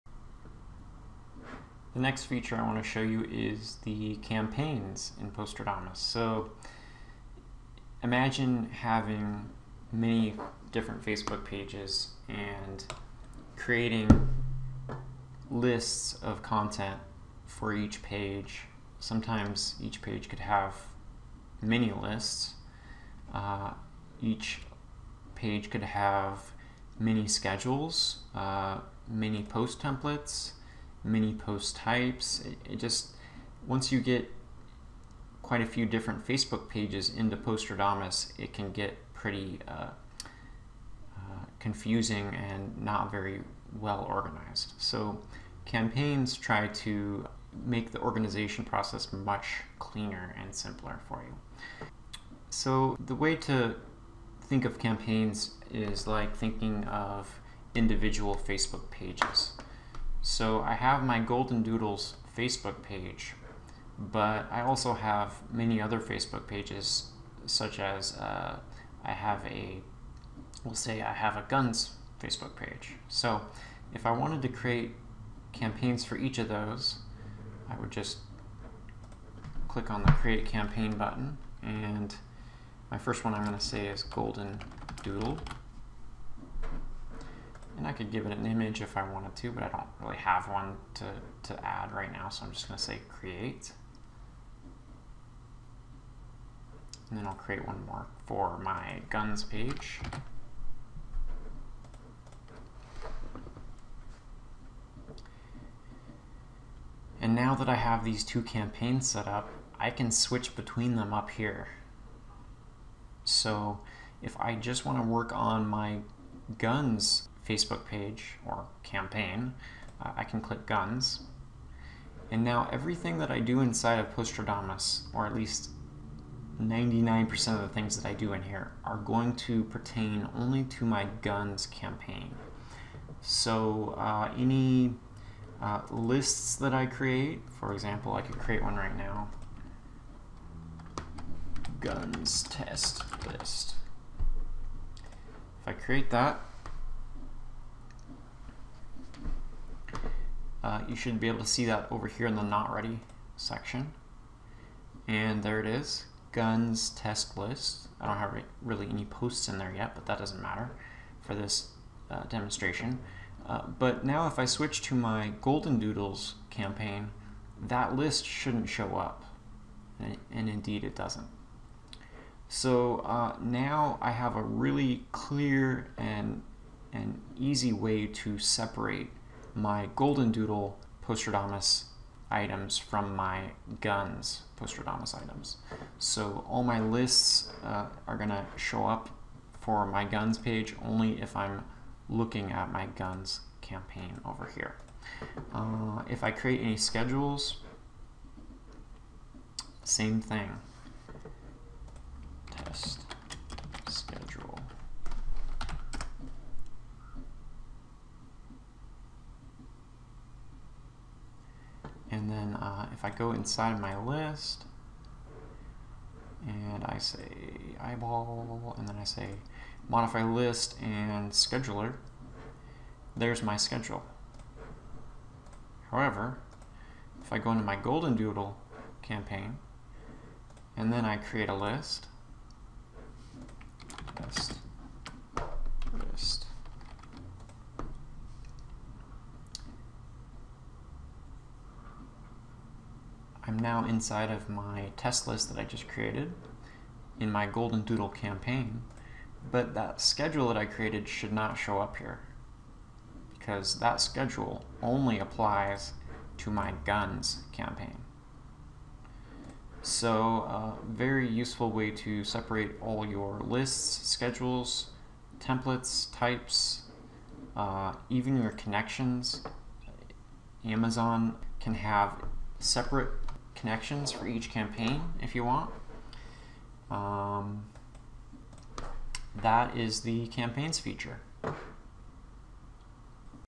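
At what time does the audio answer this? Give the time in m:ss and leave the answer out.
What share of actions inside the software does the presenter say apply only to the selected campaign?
2:06.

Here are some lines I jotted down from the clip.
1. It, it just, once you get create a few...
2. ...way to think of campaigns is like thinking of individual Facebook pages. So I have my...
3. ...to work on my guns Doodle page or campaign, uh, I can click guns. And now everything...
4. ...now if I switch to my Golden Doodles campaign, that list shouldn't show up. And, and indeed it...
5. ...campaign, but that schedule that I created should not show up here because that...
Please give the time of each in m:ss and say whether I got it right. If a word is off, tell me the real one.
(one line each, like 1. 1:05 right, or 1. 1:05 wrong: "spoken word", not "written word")
1. 0:32 wrong: "quite", not "create"
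2. 0:53 right
3. 1:54 wrong: "Facebook", not "Doodle"
4. 2:44 right
5. 4:08 right.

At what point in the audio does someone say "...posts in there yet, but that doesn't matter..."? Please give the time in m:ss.
2:39.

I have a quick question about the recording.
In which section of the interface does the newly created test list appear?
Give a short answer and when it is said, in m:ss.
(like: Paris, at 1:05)
not ready, at 2:32.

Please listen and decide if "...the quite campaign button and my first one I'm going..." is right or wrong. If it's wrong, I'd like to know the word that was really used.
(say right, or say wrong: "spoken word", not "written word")
wrong: "create", not "quite".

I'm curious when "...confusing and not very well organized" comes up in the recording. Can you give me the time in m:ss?
0:41.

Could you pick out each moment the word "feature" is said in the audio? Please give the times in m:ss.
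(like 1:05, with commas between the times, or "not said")
0:02, 4:40.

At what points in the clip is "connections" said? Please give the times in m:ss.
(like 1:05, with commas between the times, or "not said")
4:28, 4:33.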